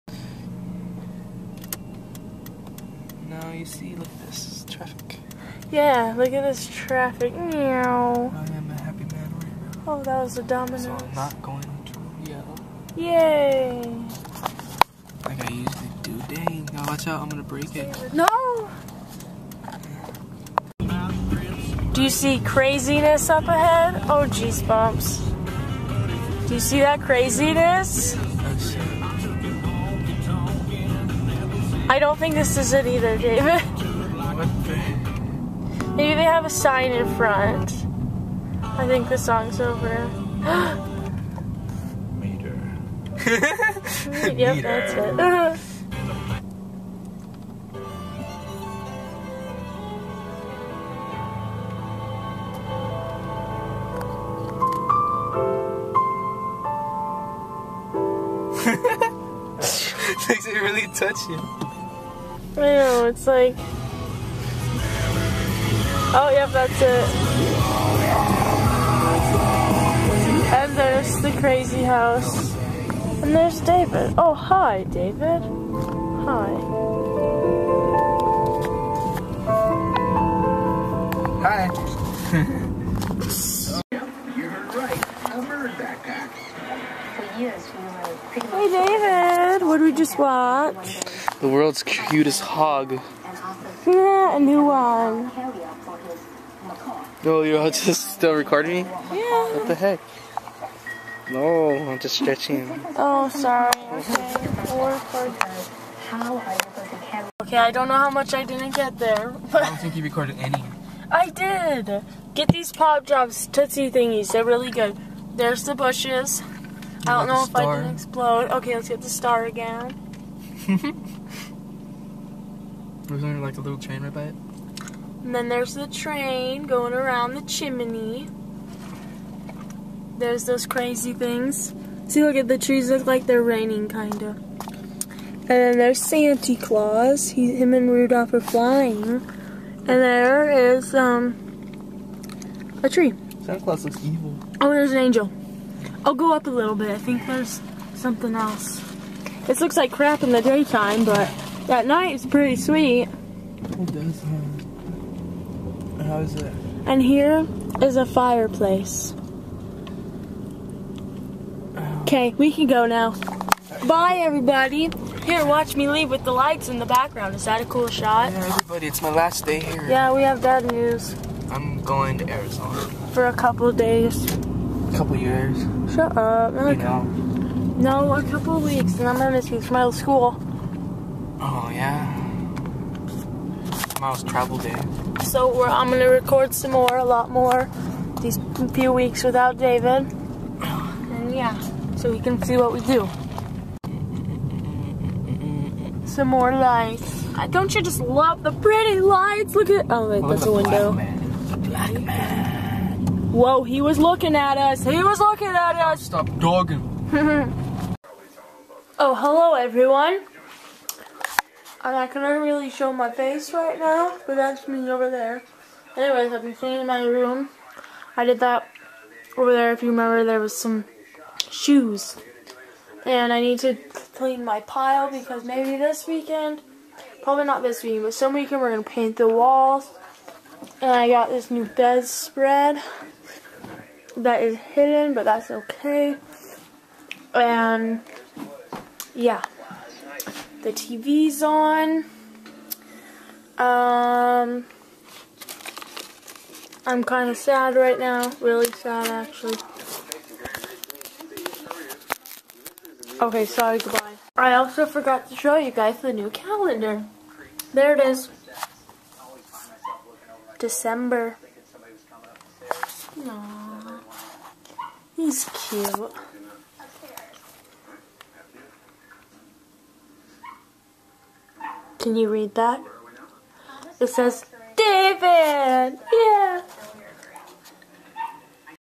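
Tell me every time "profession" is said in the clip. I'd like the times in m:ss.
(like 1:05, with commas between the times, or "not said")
not said.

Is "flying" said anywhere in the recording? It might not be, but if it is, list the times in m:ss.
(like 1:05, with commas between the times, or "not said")
2:18.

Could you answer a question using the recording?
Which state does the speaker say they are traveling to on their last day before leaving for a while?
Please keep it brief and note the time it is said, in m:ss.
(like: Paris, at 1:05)
Arizona, at 2:52.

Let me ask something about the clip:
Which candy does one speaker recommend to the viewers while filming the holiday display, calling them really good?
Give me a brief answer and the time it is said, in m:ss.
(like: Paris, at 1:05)
pop drops, at 1:52.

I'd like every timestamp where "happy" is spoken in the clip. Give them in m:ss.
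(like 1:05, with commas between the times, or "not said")
0:08.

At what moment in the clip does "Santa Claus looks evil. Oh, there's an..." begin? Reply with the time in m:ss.
2:23.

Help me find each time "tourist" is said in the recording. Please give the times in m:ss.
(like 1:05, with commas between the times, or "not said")
not said.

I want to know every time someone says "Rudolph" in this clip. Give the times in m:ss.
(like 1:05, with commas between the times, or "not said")
2:17.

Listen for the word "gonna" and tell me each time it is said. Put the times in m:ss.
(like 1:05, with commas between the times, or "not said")
0:17, 2:59.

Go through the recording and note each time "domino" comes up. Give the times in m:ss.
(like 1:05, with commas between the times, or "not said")
0:10.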